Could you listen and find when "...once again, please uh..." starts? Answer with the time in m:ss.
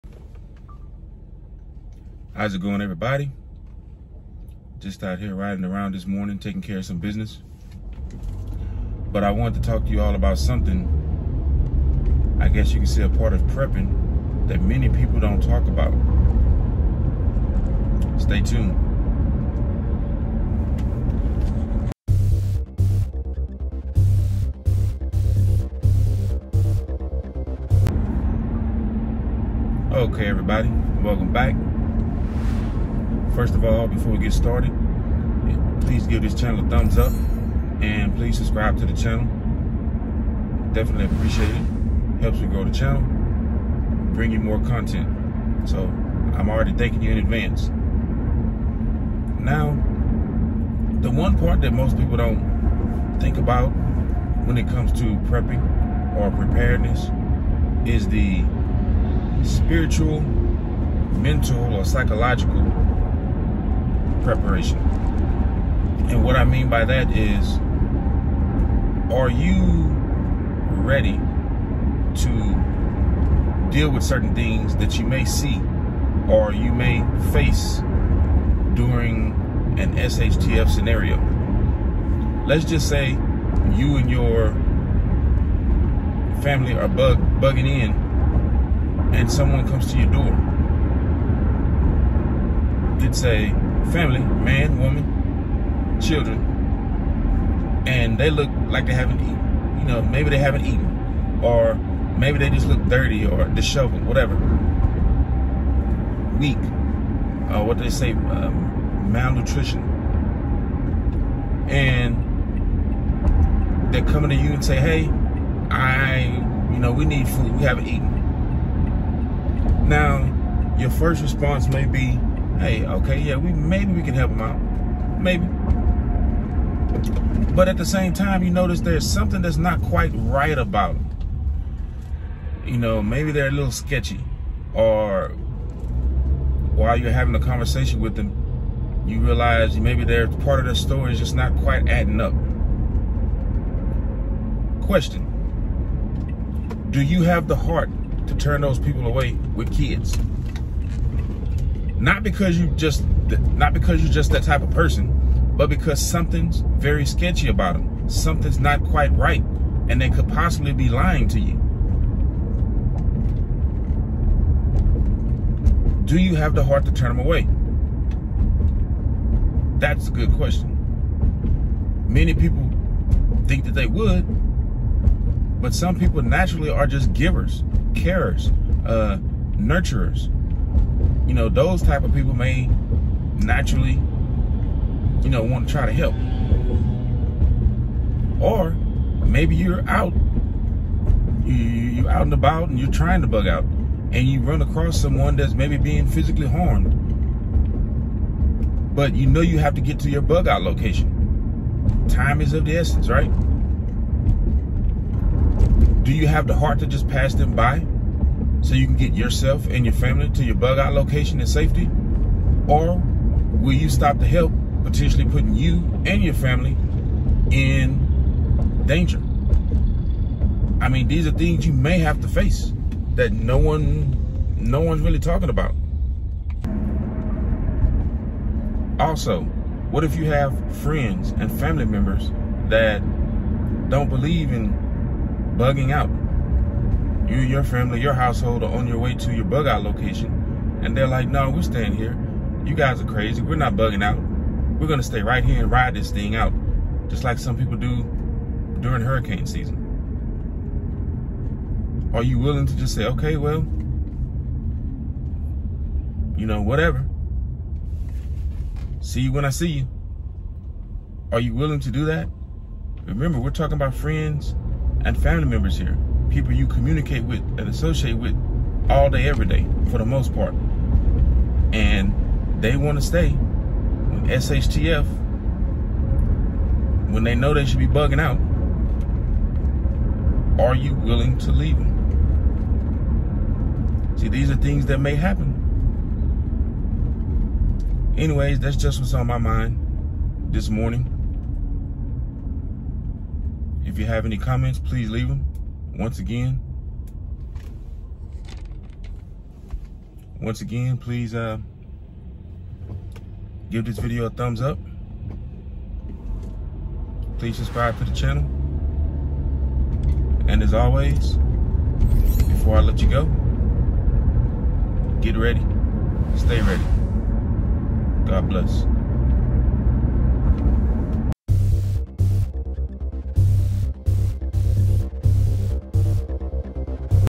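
5:00.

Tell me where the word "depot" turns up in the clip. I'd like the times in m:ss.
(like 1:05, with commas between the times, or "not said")
not said.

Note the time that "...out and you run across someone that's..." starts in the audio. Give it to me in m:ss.
3:13.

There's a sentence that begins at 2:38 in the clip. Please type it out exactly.
Something's not quite right, and they could possibly be lying to you.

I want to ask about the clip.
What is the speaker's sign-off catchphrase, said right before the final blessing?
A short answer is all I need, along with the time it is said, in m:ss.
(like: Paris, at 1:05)
Get ready, stay ready, at 5:15.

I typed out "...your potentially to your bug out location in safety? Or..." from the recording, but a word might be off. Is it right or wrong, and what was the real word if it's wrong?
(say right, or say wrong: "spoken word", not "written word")
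wrong: "family", not "potentially".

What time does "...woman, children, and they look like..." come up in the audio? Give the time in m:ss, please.
1:34.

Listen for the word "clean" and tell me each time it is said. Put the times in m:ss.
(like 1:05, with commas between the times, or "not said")
not said.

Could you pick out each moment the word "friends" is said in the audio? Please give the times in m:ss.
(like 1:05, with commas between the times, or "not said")
3:50, 4:23.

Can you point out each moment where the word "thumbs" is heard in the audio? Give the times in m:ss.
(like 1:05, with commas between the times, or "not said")
0:36, 5:04.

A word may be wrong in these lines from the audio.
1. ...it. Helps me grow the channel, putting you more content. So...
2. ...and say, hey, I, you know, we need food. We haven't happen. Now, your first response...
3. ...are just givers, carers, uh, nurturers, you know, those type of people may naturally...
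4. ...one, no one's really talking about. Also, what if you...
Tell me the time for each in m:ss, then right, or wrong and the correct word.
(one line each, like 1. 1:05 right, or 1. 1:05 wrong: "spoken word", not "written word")
1. 0:41 wrong: "bring", not "putting"
2. 1:54 wrong: "eaten", not "happen"
3. 2:56 right
4. 3:43 right.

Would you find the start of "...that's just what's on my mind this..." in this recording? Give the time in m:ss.
4:48.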